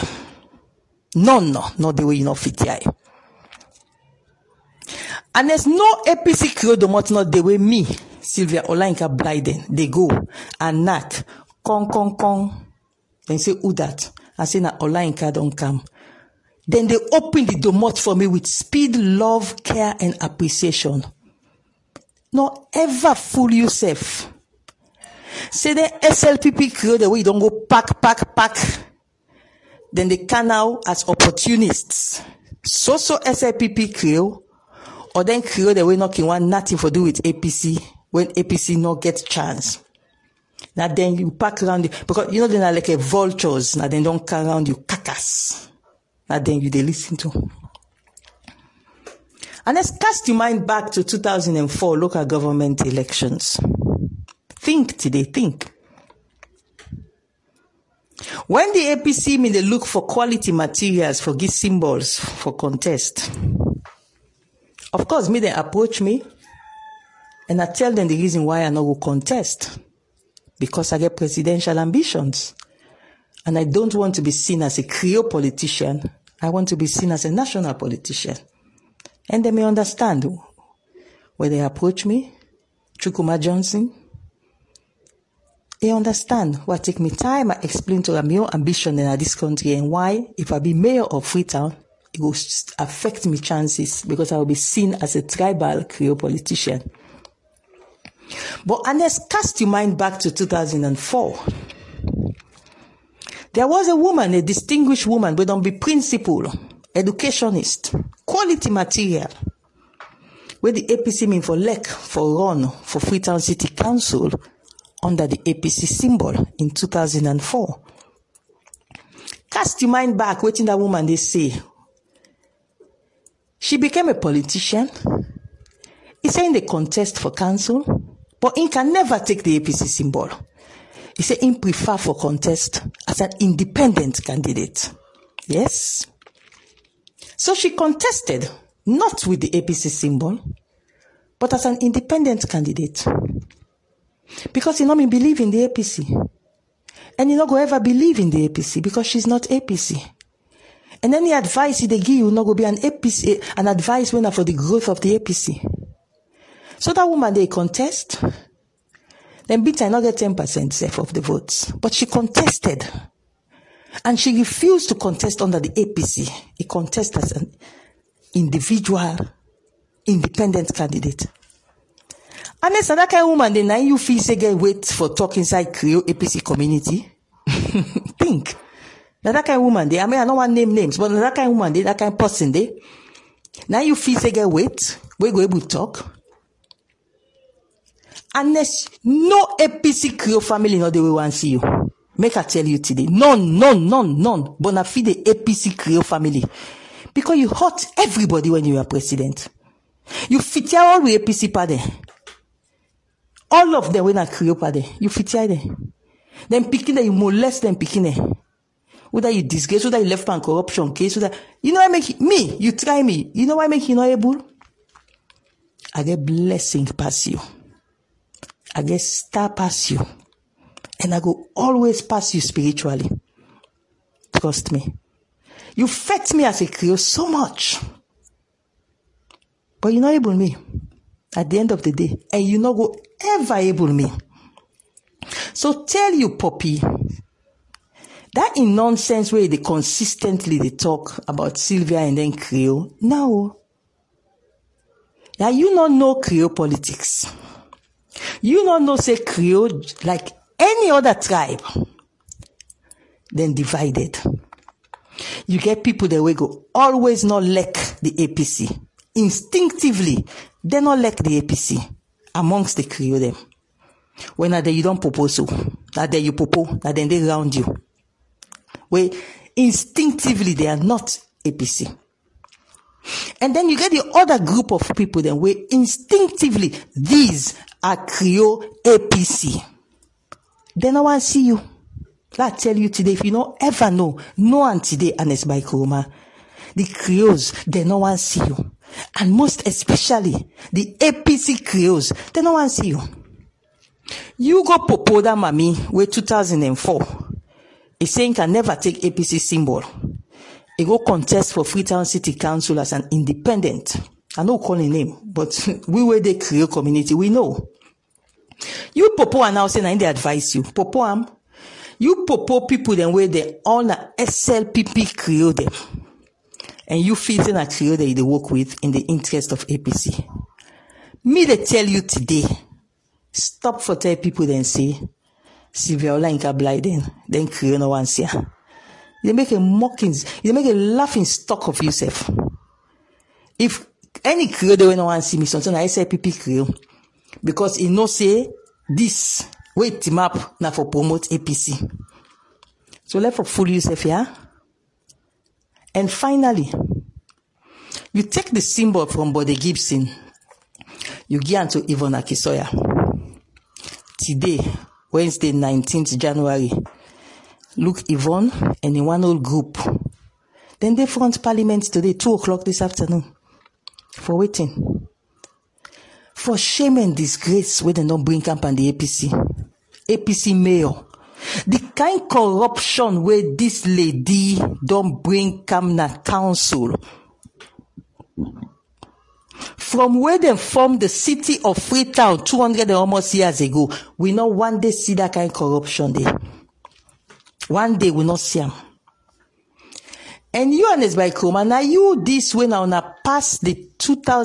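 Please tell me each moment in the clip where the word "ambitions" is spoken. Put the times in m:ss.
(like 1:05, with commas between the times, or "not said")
1:11, 1:28.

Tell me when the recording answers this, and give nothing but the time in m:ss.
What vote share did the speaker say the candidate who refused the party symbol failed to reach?
2:40.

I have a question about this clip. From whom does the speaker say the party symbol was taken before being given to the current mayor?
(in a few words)
Bode Gibson.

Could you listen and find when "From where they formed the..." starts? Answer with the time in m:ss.
6:19.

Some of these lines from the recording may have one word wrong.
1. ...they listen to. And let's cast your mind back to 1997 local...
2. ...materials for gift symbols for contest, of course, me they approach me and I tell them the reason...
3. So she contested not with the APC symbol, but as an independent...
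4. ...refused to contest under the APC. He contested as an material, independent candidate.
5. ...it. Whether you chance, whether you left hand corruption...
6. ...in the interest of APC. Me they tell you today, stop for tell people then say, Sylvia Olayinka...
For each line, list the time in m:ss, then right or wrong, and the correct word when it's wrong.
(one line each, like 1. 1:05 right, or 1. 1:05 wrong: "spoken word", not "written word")
1. 0:46 wrong: "2004", not "1997"
2. 1:00 right
3. 2:17 right
4. 2:44 wrong: "individual", not "material"
5. 3:28 wrong: "disgrace", not "chance"
6. 5:18 right.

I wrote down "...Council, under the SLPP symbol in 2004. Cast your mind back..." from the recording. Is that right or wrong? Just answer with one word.
wrong.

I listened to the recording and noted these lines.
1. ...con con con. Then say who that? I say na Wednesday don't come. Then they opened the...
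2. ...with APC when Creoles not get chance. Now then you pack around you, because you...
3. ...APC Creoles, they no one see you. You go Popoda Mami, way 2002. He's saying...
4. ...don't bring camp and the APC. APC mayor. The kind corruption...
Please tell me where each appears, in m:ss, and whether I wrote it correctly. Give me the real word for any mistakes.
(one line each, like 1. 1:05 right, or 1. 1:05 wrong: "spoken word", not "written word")
1. 0:11 wrong: "Olayinka", not "Wednesday"
2. 0:37 wrong: "APC", not "Creoles"
3. 4:50 wrong: "2004", not "2002"
4. 6:08 right.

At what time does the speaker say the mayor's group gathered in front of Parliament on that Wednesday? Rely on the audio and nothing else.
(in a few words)
2 o'clock.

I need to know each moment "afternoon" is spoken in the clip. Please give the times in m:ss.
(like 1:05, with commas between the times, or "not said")
6:02.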